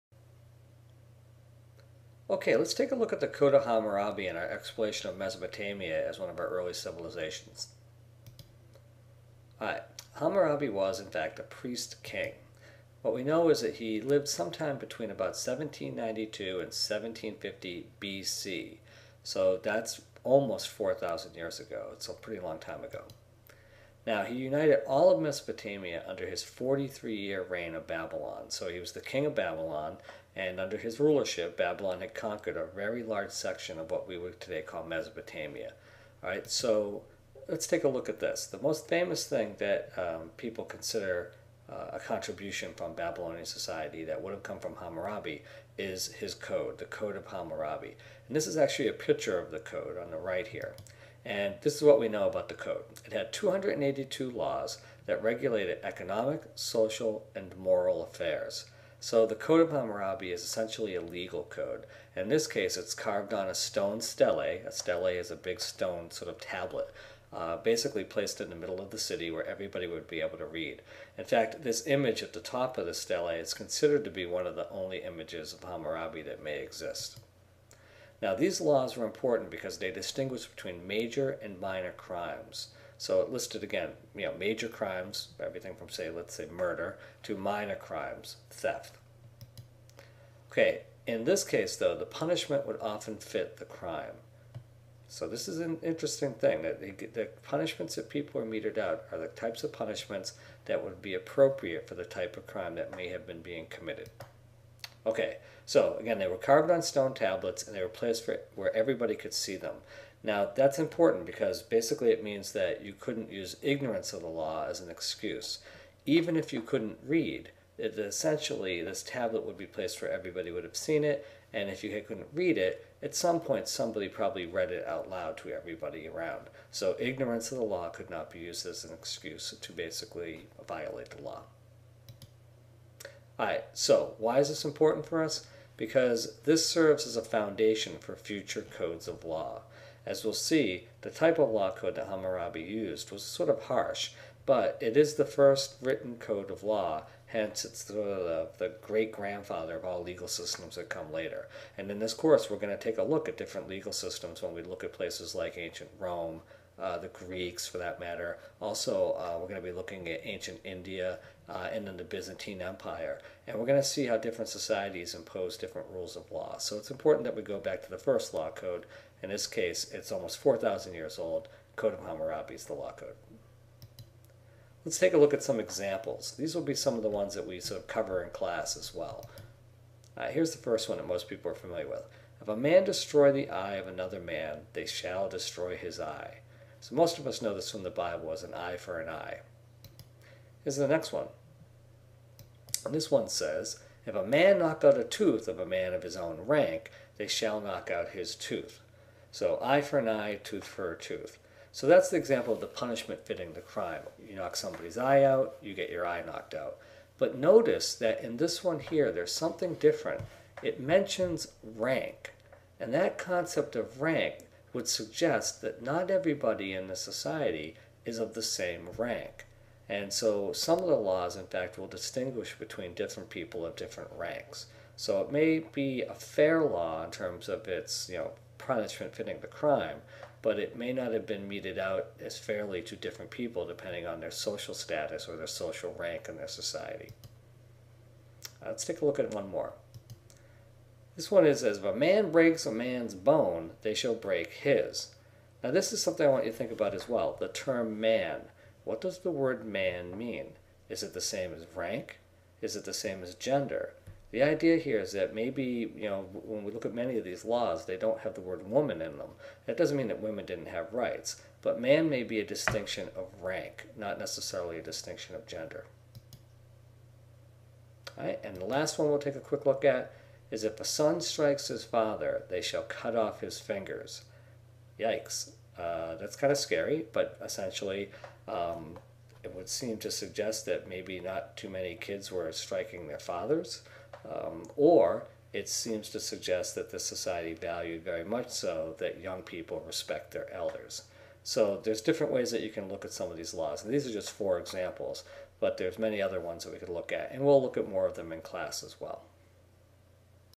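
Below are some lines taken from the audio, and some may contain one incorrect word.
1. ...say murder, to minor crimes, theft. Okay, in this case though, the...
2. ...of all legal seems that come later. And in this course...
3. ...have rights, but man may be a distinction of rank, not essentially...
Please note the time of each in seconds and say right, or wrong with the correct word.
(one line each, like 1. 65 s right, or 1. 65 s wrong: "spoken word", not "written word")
1. 86 s right
2. 149 s wrong: "systems", not "seems"
3. 260 s wrong: "necessarily", not "essentially".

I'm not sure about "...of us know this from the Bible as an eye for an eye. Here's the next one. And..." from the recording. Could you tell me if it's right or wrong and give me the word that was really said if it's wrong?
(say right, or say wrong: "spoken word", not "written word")
right.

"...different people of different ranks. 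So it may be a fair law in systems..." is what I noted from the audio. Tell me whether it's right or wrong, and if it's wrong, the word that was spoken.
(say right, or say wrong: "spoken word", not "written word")
wrong: "terms", not "systems".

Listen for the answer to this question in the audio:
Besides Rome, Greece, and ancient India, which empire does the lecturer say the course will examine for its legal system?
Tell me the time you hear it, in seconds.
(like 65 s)
162 s.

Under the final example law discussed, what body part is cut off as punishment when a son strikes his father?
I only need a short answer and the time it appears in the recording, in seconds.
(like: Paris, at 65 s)
fingers, at 273 s.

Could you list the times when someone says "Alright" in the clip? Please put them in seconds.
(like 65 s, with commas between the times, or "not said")
9 s, 133 s.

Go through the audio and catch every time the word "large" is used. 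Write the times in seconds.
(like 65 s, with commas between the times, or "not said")
33 s.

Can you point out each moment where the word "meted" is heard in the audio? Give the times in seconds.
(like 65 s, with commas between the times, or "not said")
98 s, 231 s.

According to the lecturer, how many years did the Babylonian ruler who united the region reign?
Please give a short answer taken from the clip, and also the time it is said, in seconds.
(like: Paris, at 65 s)
43, at 26 s.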